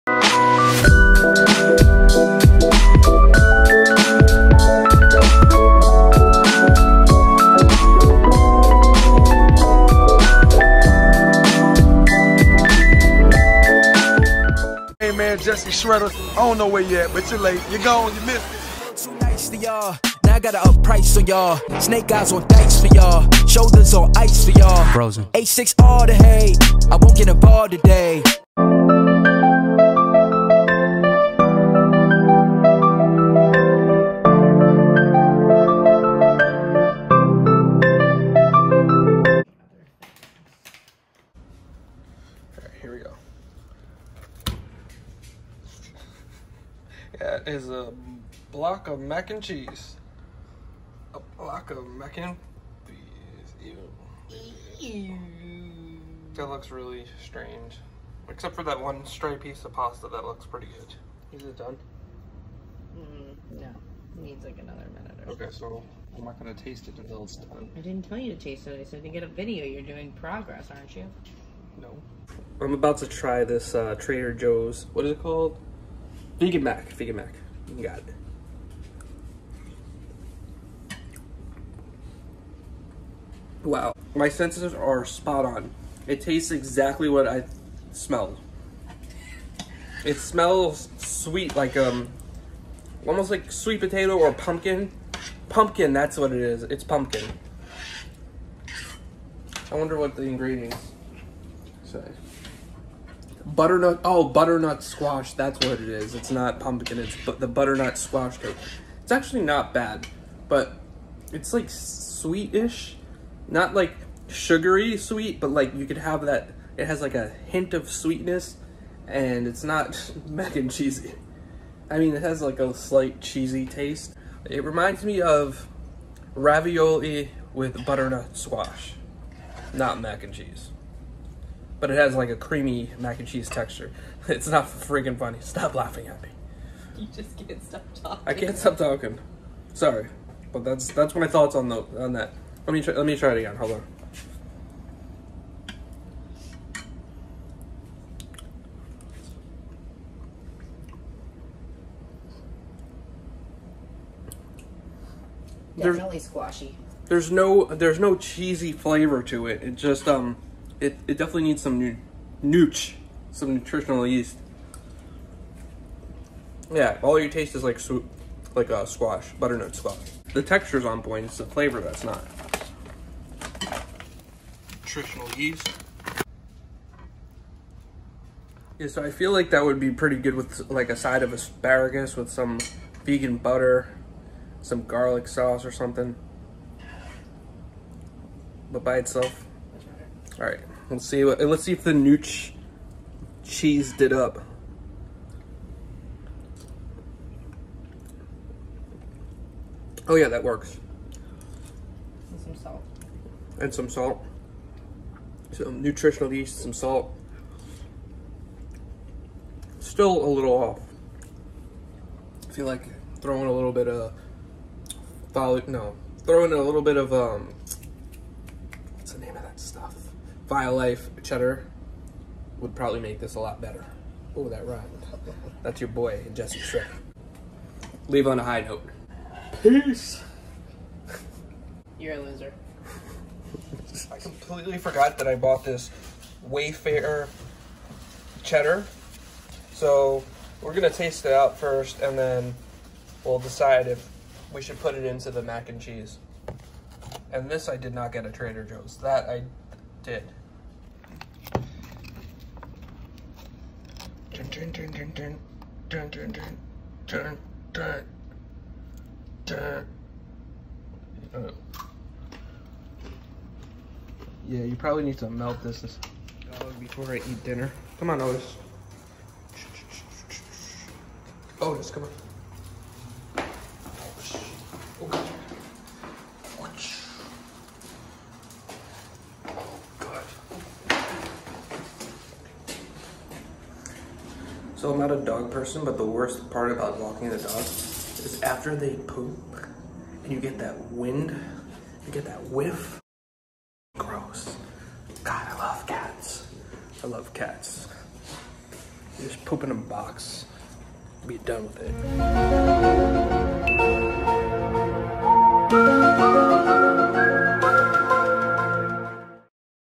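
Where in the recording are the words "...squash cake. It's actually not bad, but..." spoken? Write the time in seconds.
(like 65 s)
107 s.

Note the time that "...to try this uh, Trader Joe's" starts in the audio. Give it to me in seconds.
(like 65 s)
72 s.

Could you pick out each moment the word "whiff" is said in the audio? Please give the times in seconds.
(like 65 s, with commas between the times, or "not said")
292 s.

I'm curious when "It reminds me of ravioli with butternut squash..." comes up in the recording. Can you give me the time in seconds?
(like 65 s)
124 s.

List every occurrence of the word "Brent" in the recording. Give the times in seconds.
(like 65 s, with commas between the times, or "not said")
not said.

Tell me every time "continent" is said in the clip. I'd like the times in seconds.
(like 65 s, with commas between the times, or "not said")
not said.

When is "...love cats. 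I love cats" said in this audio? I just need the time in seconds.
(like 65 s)
295 s.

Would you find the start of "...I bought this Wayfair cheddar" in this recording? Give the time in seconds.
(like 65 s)
235 s.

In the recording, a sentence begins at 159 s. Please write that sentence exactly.
It just um it, it definitely needs some new nooch, some nutritional yeast.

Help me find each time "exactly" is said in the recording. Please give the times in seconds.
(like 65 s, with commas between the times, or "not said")
86 s.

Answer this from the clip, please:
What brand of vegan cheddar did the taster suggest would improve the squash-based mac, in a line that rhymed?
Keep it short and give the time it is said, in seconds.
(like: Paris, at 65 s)
Life cheddar, at 220 s.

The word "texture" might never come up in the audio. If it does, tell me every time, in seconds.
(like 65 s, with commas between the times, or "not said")
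133 s, 170 s.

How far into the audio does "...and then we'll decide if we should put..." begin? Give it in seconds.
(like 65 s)
242 s.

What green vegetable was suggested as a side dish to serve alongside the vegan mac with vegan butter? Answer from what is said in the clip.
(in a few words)
Asparagus.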